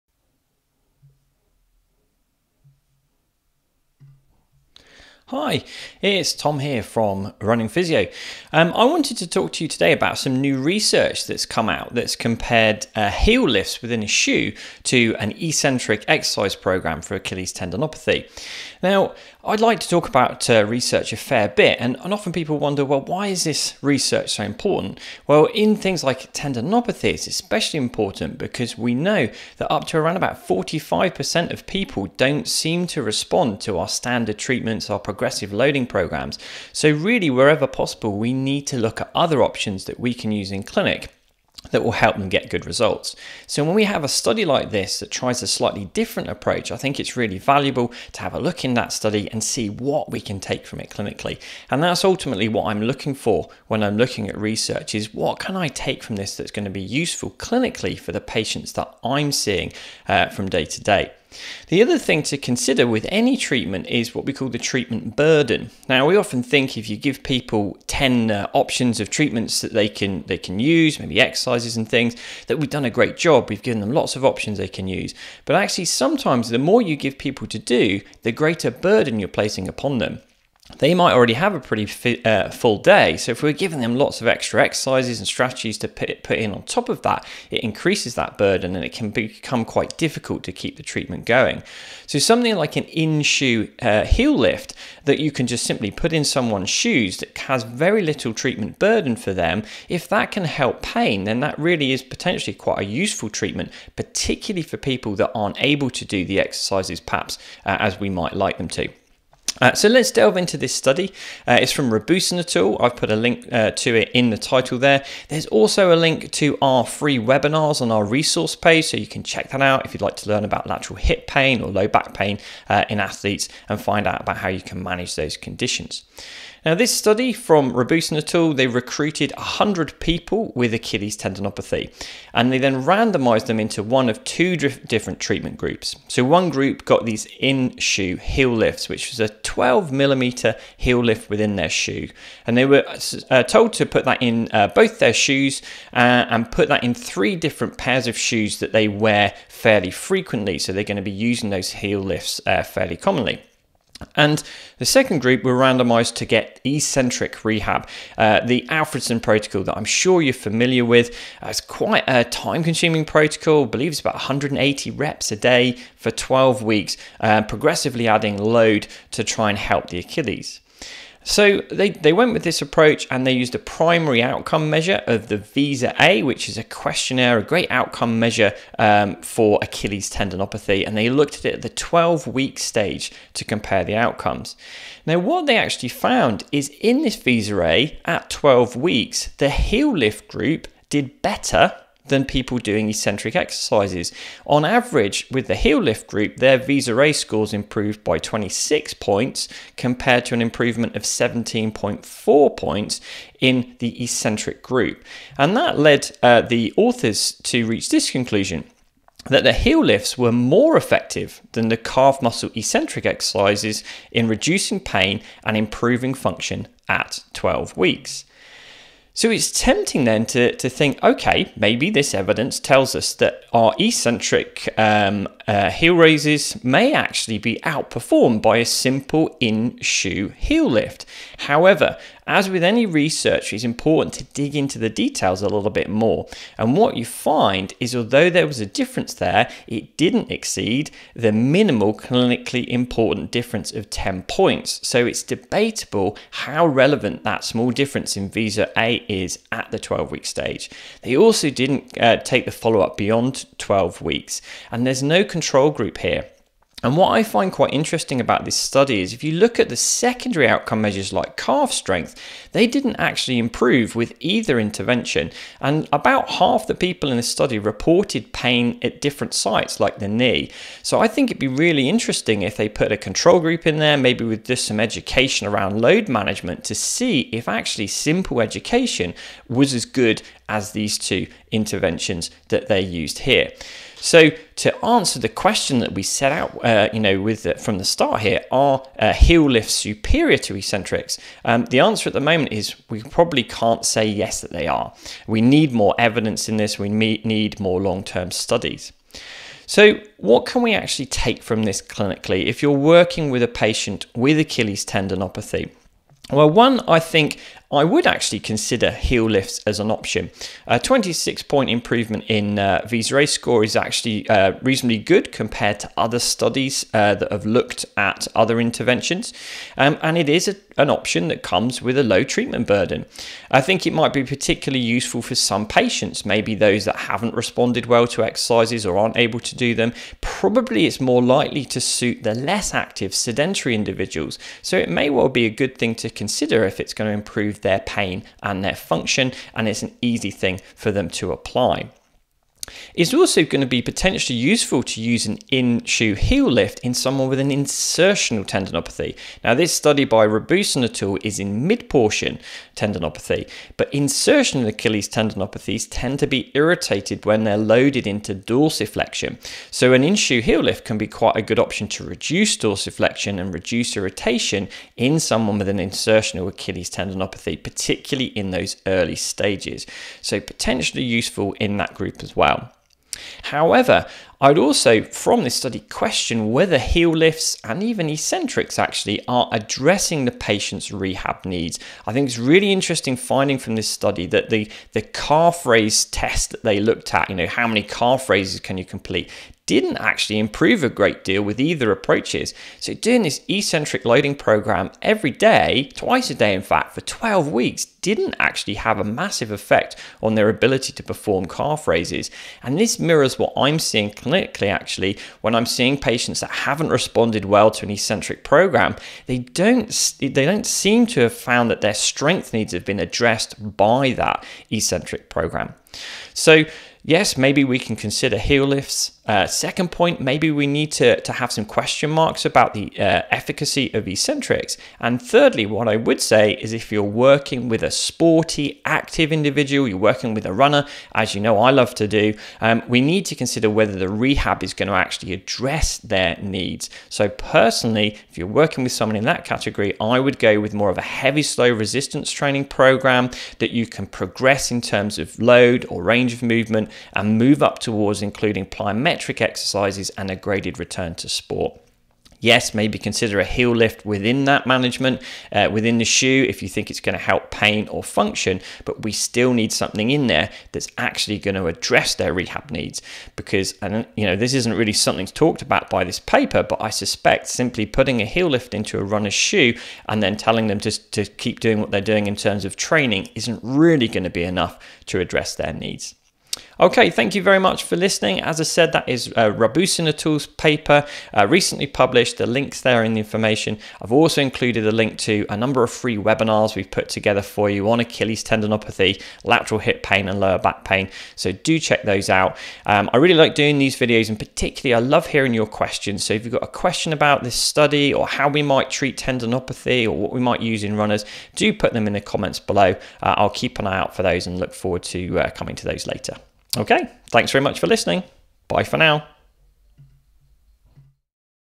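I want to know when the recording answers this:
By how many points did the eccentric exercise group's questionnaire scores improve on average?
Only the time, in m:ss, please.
3:21.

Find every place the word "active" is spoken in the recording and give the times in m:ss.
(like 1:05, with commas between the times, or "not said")
5:32, 7:08.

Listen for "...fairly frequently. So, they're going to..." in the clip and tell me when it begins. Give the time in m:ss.
2:29.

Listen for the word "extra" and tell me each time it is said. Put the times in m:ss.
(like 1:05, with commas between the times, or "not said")
1:24.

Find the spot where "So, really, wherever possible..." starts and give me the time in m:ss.
0:36.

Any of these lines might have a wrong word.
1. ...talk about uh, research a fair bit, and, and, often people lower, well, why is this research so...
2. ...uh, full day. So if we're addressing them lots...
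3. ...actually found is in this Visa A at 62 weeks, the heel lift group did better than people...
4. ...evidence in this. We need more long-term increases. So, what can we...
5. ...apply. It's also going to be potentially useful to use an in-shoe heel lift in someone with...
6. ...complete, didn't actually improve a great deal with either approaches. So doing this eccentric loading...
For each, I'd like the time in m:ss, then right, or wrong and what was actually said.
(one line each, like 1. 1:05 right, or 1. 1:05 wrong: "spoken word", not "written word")
1. 0:19 wrong: "wonder", not "lower"
2. 1:22 wrong: "giving", not "addressing"
3. 3:05 wrong: "12", not "62"
4. 4:55 wrong: "studies", not "increases"
5. 5:41 right
6. 6:28 right.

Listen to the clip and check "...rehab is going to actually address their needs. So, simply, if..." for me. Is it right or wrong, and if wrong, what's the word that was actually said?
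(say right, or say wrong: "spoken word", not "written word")
wrong: "personally", not "simply".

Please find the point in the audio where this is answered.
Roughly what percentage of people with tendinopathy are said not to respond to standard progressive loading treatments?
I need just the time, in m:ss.
0:30.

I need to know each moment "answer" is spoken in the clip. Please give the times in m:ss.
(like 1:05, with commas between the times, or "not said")
4:44, 4:51.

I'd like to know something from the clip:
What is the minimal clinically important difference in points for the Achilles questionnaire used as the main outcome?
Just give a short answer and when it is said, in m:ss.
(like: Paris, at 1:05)
10 points, at 4:03.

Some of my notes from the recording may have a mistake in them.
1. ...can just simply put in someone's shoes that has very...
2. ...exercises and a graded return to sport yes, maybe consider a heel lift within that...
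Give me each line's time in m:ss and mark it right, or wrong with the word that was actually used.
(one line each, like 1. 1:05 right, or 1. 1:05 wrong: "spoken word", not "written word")
1. 1:35 right
2. 7:29 right.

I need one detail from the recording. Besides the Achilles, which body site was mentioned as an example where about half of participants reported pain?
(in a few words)
The knee.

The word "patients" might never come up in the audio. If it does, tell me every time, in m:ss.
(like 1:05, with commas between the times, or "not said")
0:58, 5:03, 5:25, 6:20, 6:45.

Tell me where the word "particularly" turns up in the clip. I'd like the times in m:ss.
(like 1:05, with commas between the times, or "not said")
1:43, 5:24, 6:07, 8:14.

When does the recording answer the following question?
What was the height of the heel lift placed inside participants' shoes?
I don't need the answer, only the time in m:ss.
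2:19.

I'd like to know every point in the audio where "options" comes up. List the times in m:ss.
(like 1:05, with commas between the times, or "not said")
0:39, 1:08, 1:14, 5:09, 5:20, 6:01.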